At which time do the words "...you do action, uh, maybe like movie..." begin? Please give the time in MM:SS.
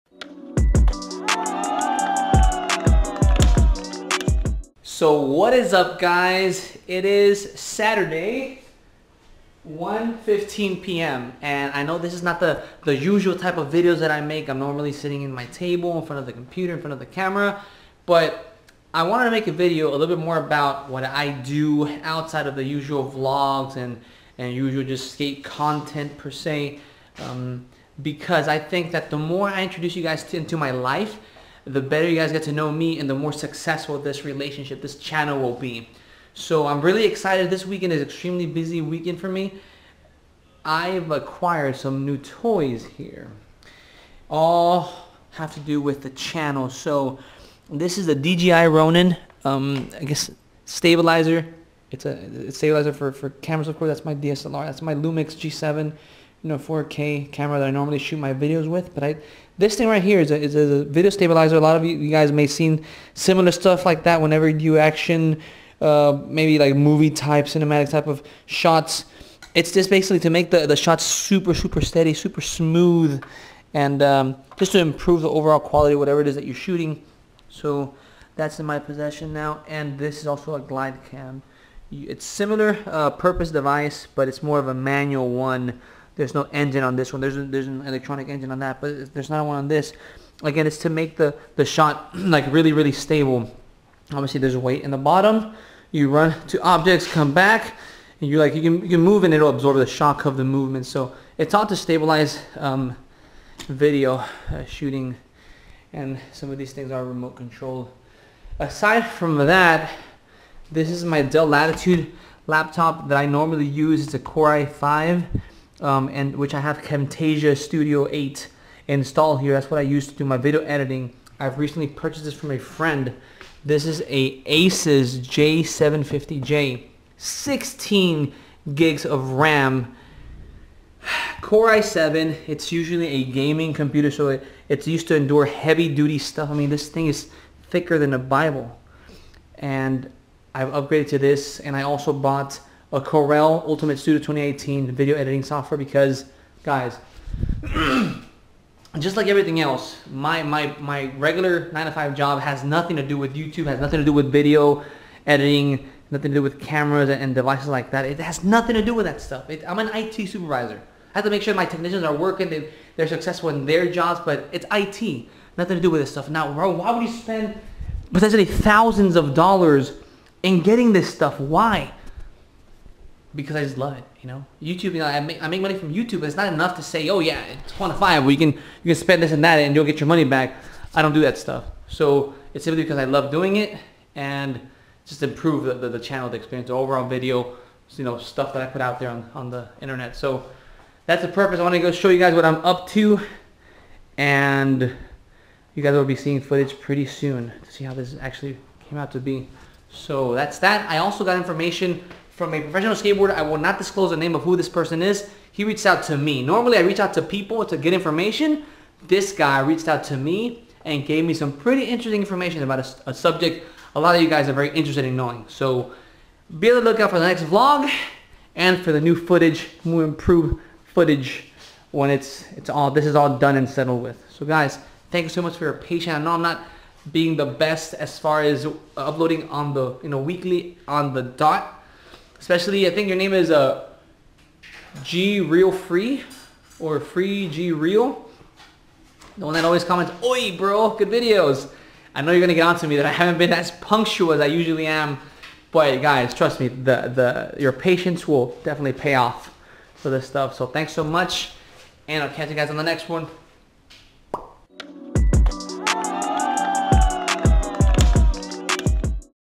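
01:04.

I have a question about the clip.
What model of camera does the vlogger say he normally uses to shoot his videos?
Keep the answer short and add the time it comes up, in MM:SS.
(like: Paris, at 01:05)
Lumix G7, at 00:54.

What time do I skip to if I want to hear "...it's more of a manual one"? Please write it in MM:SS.
01:24.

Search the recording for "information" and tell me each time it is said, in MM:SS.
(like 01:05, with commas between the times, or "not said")
03:21, 03:27, 03:32.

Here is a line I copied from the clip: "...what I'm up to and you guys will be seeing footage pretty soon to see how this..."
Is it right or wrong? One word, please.
right.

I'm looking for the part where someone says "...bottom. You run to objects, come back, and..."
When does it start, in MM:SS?
01:34.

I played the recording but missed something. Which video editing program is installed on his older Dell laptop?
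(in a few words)
Camtasia Studio 8.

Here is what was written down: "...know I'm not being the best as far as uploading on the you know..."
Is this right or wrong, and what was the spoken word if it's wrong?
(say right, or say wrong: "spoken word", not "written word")
right.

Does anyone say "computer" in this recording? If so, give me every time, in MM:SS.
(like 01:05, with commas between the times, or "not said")
00:16, 02:13.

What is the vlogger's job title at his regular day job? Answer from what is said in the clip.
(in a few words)
IT supervisor.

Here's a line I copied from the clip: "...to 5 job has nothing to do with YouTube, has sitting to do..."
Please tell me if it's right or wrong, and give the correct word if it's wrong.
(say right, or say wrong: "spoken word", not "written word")
wrong: "nothing", not "sitting".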